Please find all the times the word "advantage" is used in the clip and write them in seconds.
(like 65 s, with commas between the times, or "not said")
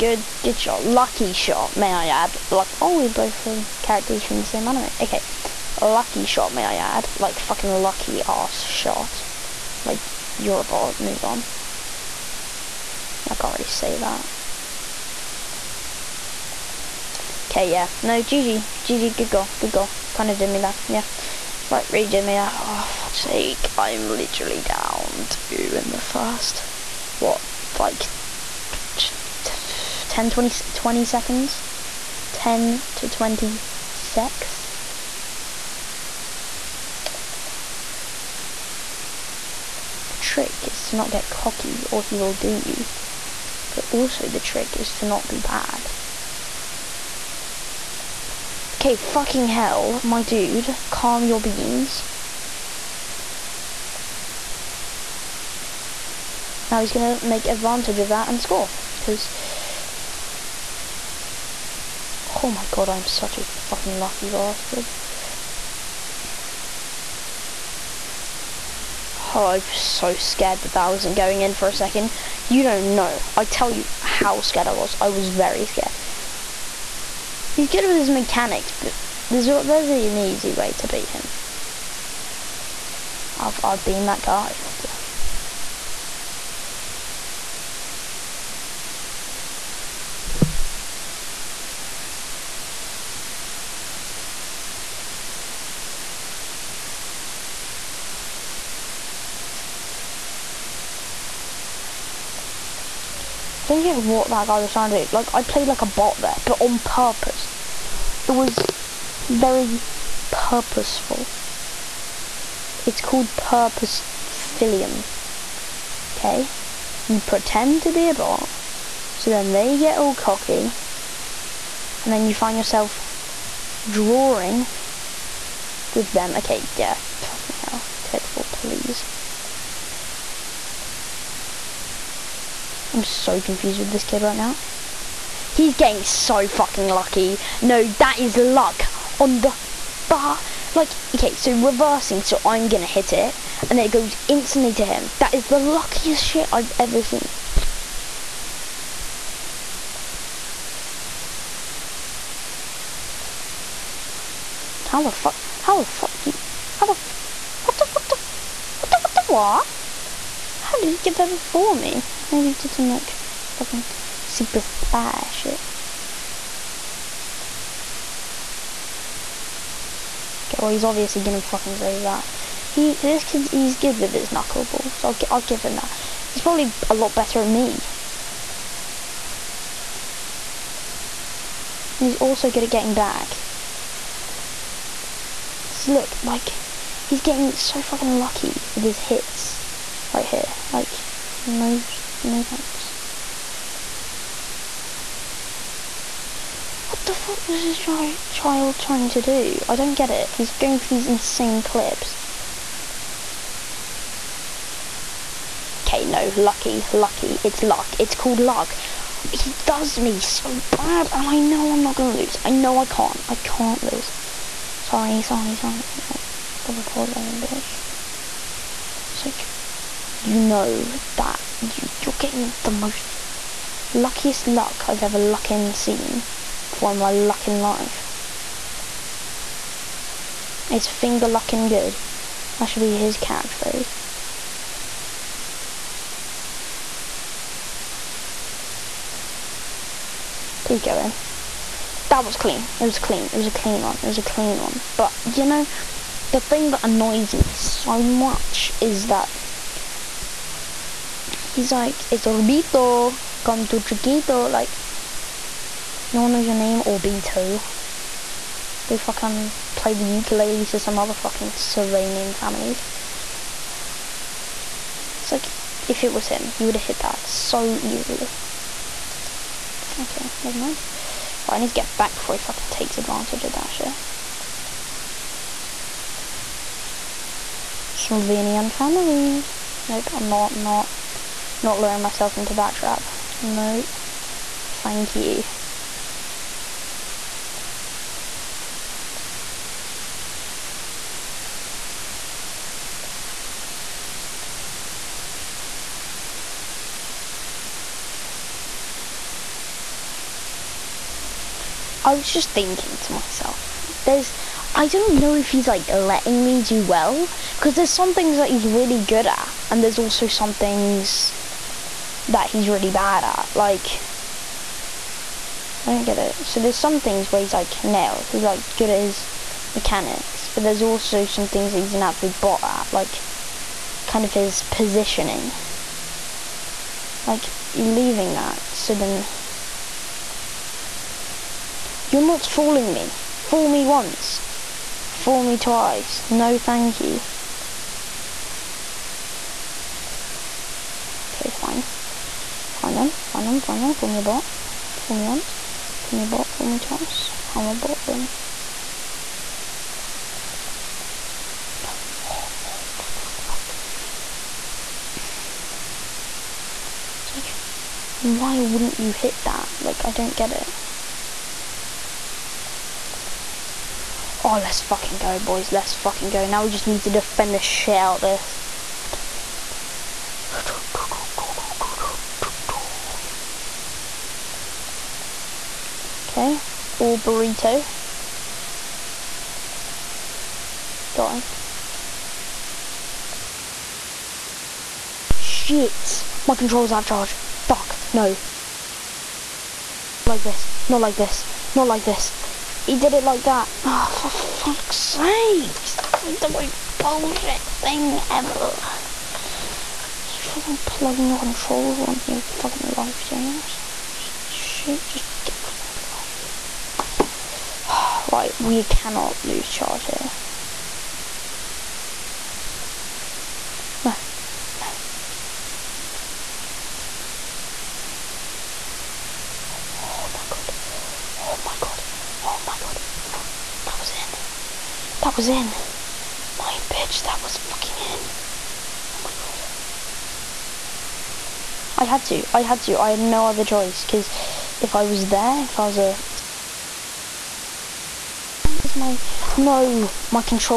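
57 s, 272 s.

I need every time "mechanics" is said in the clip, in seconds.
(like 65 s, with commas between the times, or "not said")
78 s, 319 s.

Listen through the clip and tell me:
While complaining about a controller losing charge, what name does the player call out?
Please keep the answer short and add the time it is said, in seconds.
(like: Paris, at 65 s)
James, at 403 s.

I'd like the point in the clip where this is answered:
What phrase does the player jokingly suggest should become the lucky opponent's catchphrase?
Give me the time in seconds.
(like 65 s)
230 s.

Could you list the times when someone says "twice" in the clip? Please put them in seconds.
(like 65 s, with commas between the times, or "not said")
335 s, 346 s.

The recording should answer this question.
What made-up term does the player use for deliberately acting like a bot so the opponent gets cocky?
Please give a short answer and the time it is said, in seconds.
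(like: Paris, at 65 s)
purpose philium, at 113 s.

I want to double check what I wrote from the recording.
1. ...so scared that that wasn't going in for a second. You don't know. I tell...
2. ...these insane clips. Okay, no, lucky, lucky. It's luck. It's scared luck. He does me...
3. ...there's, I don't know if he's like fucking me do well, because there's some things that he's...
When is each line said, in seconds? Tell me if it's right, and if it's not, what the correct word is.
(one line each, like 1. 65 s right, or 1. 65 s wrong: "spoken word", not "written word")
1. 69 s right
2. 200 s wrong: "called", not "scared"
3. 304 s wrong: "letting", not "fucking".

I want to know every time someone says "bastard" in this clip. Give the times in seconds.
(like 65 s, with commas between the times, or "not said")
64 s.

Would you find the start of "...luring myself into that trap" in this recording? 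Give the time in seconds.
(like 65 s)
281 s.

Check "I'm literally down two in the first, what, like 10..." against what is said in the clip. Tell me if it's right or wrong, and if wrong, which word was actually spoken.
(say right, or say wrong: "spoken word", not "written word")
right.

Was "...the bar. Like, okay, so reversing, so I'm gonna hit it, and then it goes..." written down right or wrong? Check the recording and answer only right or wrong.
right.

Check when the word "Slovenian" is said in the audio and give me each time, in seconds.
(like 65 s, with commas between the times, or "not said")
261 s, 277 s.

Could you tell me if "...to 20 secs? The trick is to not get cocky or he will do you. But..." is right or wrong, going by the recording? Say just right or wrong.
right.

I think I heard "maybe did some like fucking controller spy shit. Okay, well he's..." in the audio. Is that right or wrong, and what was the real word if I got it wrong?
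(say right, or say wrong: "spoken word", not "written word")
wrong: "super", not "controller".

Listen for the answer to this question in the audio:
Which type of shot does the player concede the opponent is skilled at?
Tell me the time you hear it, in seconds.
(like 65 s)
174 s.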